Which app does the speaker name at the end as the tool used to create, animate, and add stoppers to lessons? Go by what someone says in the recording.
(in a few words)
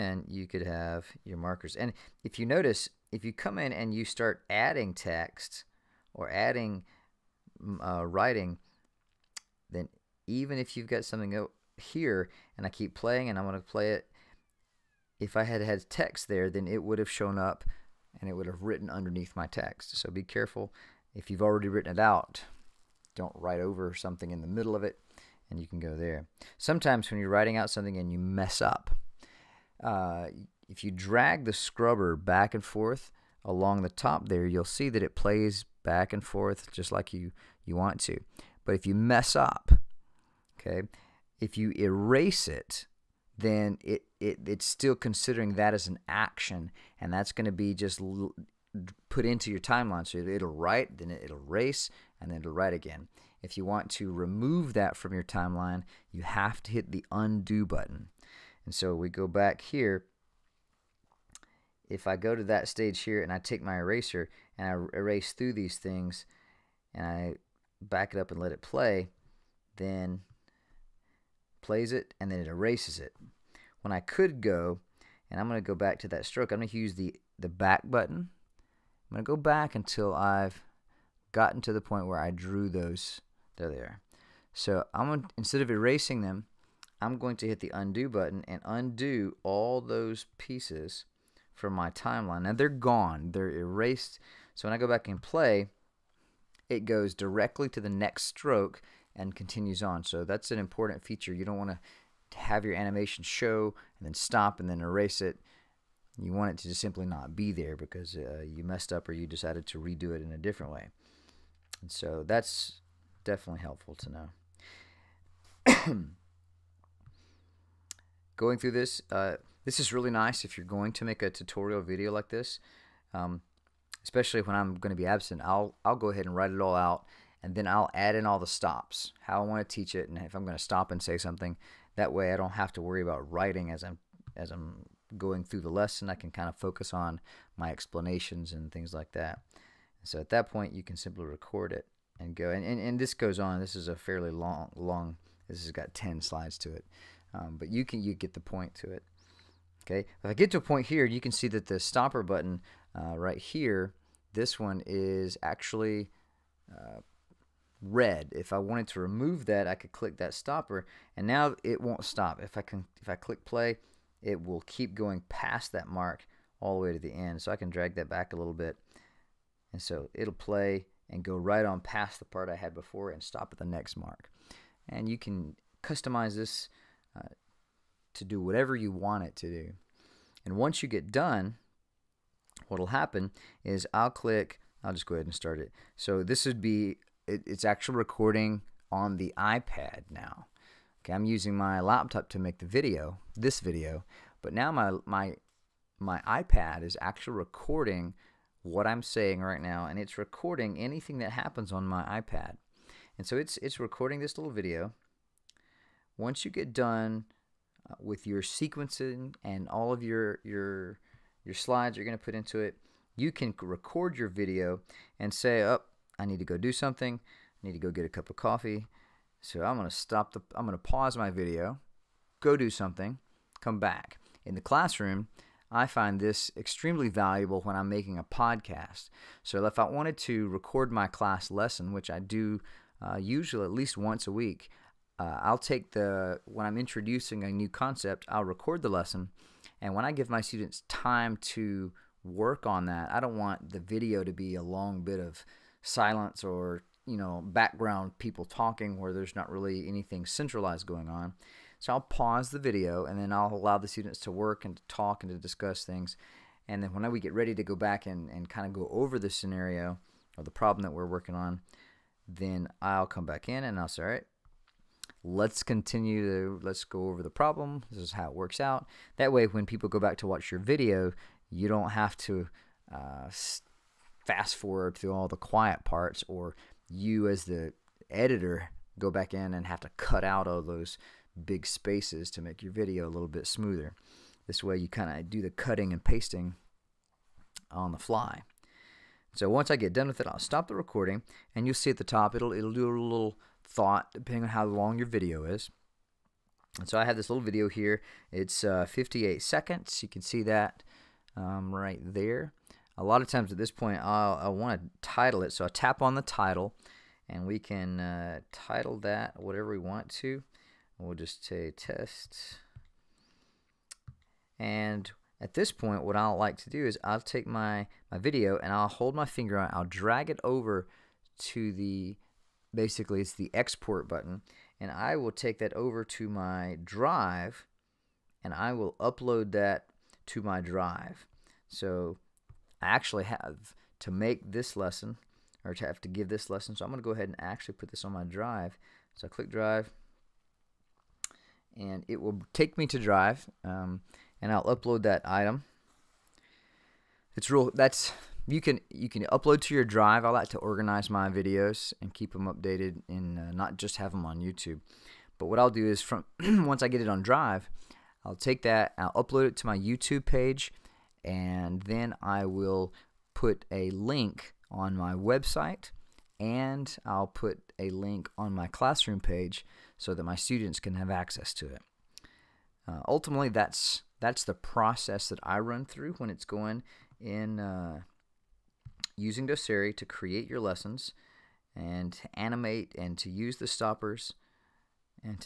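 Doceri.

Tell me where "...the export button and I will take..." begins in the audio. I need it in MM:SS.
05:23.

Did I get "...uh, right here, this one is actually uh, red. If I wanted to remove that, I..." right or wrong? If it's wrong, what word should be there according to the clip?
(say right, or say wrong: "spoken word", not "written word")
right.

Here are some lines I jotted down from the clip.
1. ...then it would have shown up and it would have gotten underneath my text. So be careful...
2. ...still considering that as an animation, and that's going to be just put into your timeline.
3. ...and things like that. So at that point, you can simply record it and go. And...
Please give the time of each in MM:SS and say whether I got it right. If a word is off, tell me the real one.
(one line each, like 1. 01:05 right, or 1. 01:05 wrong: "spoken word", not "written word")
1. 00:16 wrong: "written", not "gotten"
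2. 00:44 wrong: "action", not "animation"
3. 02:18 right.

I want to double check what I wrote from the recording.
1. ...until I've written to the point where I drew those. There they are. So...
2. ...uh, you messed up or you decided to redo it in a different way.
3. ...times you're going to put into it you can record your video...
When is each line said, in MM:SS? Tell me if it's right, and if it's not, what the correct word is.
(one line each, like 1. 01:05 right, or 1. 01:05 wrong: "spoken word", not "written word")
1. 01:19 wrong: "gotten", not "written"
2. 01:48 right
3. 03:31 wrong: "slides", not "times".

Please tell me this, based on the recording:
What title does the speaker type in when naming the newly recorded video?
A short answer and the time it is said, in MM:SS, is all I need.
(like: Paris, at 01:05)
test, at 05:11.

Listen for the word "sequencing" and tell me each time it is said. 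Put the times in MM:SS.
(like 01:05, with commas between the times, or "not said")
03:28.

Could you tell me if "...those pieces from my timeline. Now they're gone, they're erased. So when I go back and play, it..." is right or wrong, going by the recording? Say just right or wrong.
right.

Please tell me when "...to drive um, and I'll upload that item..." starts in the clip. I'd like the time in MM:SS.
05:42.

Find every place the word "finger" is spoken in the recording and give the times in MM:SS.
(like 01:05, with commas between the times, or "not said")
05:19.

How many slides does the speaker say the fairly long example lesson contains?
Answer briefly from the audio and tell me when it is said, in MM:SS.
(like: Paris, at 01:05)
10, at 02:25.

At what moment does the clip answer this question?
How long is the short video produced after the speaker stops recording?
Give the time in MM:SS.
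04:58.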